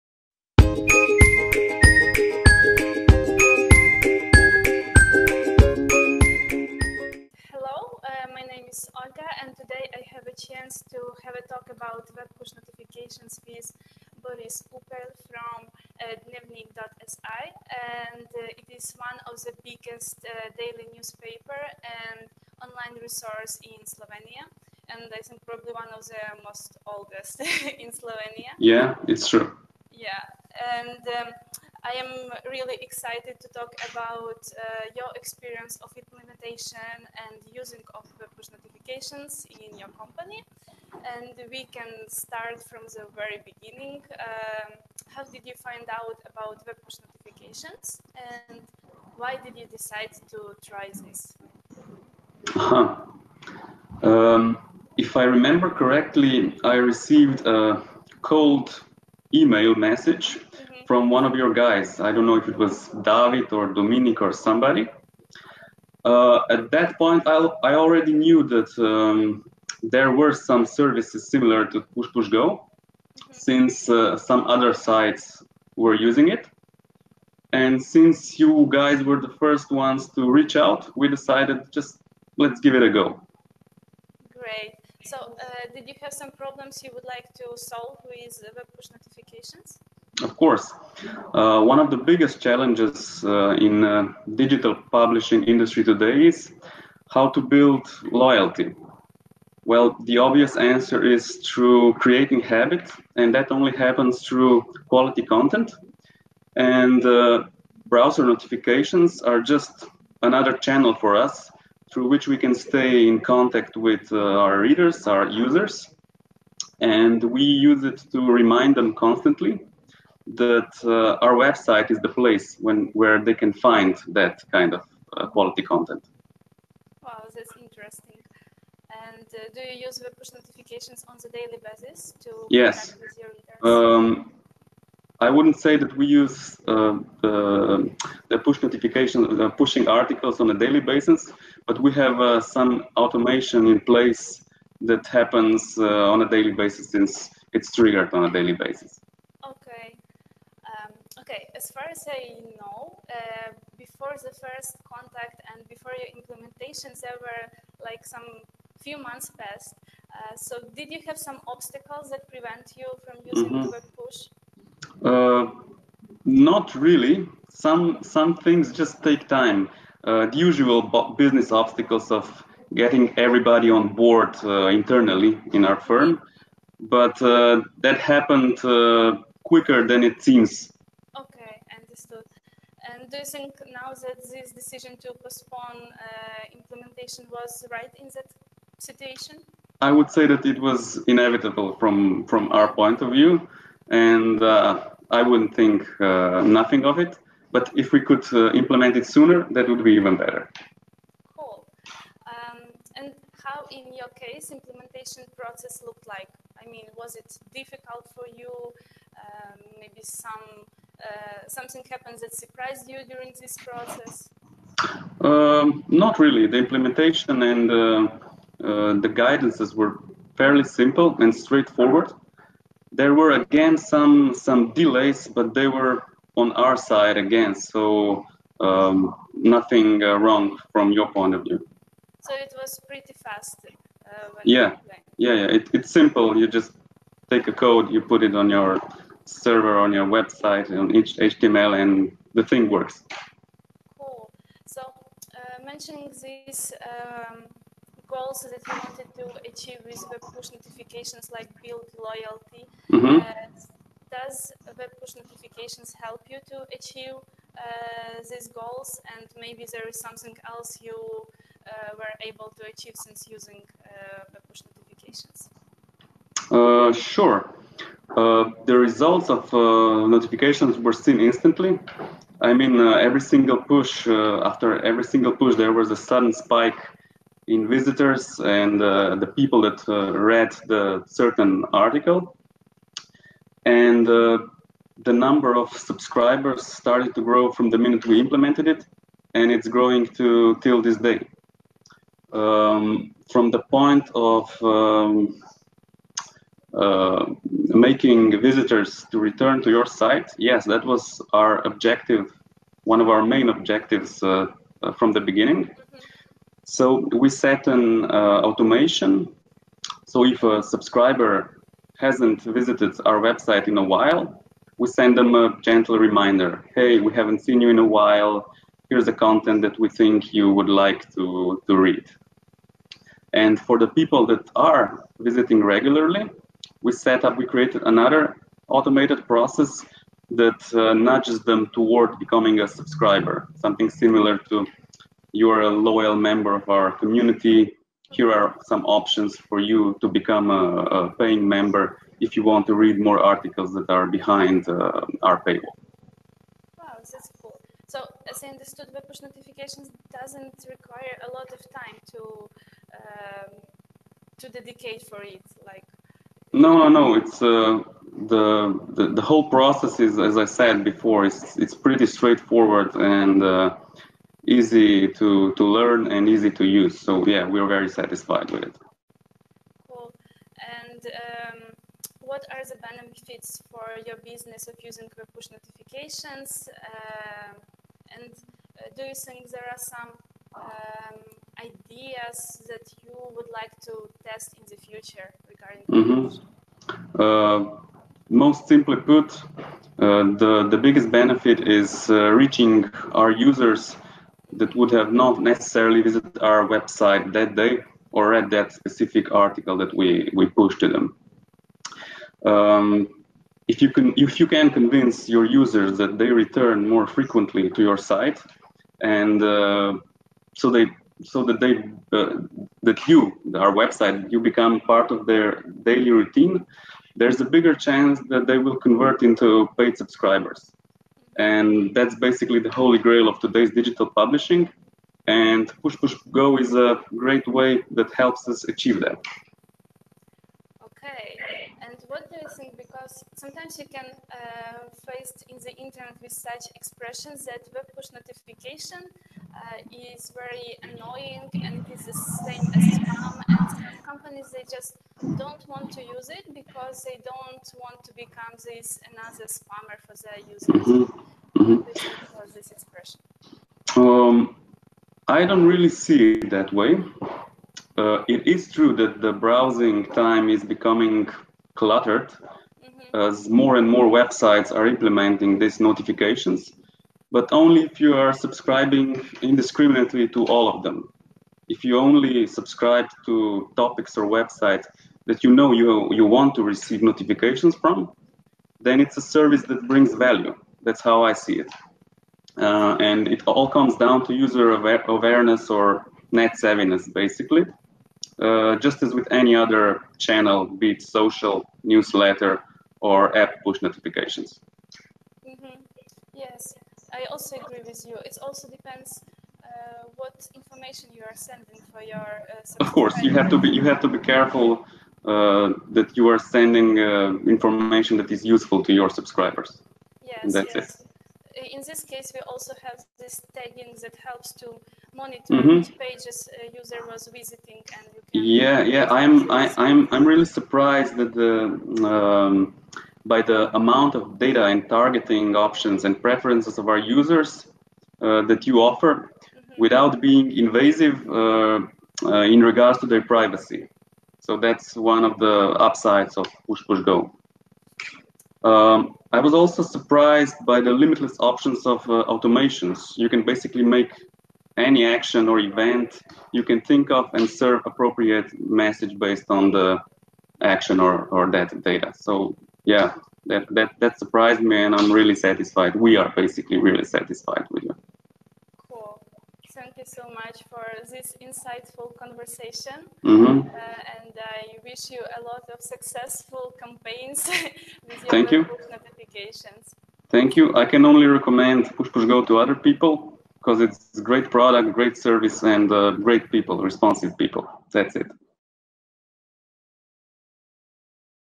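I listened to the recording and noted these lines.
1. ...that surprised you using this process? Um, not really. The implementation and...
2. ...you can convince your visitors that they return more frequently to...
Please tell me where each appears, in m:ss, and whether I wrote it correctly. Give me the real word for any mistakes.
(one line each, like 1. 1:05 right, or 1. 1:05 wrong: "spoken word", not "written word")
1. 3:32 wrong: "during", not "using"
2. 6:44 wrong: "users", not "visitors".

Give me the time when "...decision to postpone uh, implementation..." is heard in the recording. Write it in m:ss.
3:04.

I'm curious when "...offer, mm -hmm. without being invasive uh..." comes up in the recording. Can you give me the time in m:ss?
8:48.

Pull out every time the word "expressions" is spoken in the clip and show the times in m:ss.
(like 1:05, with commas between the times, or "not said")
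7:16, 7:32.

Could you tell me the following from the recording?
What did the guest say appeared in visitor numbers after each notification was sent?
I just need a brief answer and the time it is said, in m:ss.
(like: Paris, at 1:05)
sudden spike, at 4:35.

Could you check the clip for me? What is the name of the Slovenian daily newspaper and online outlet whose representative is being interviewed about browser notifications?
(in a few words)
Dnevnik.si.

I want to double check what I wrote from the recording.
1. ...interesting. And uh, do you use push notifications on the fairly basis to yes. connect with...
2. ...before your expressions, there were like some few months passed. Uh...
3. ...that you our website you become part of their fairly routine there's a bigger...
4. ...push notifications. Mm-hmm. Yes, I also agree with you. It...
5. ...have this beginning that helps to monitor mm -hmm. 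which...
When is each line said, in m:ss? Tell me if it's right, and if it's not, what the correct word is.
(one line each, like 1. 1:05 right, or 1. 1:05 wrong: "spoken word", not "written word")
1. 2:07 wrong: "daily", not "fairly"
2. 2:35 wrong: "implementations", not "expressions"
3. 6:52 wrong: "daily", not "fairly"
4. 8:13 right
5. 8:32 wrong: "tagging", not "beginning".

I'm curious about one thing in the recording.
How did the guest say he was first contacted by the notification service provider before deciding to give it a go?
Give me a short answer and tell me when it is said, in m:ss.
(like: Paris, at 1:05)
cold email message, at 0:58.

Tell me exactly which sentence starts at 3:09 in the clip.
I would say that it was inevitable from from our point of view, and uh, I wouldn't think uh, nothing of it.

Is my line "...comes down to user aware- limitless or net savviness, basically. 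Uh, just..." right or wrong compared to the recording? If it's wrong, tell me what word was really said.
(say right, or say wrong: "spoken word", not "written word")
wrong: "awareness", not "limitless".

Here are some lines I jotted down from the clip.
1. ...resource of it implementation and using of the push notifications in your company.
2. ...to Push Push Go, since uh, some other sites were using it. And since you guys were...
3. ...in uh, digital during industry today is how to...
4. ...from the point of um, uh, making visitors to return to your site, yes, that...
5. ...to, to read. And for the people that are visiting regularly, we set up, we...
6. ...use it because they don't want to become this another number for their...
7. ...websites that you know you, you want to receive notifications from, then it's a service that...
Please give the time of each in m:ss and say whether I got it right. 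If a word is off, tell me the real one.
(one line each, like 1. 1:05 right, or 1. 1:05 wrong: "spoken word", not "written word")
1. 0:35 wrong: "experience", not "resource"
2. 1:11 right
3. 1:33 wrong: "publishing", not "during"
4. 4:53 right
5. 5:21 right
6. 7:26 wrong: "spammer", not "number"
7. 7:54 right.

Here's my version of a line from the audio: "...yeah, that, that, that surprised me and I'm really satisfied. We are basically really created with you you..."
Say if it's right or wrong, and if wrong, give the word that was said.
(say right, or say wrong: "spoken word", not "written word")
wrong: "satisfied", not "created".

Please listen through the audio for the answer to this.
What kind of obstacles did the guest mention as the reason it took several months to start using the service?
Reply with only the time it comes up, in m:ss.
2:51.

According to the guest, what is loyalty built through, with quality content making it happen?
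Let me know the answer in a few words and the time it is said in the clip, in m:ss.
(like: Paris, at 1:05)
creating habit, at 1:41.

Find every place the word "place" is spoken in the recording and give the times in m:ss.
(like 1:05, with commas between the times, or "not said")
2:02, 2:23.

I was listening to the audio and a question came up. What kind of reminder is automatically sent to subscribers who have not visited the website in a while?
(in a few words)
gentle reminder.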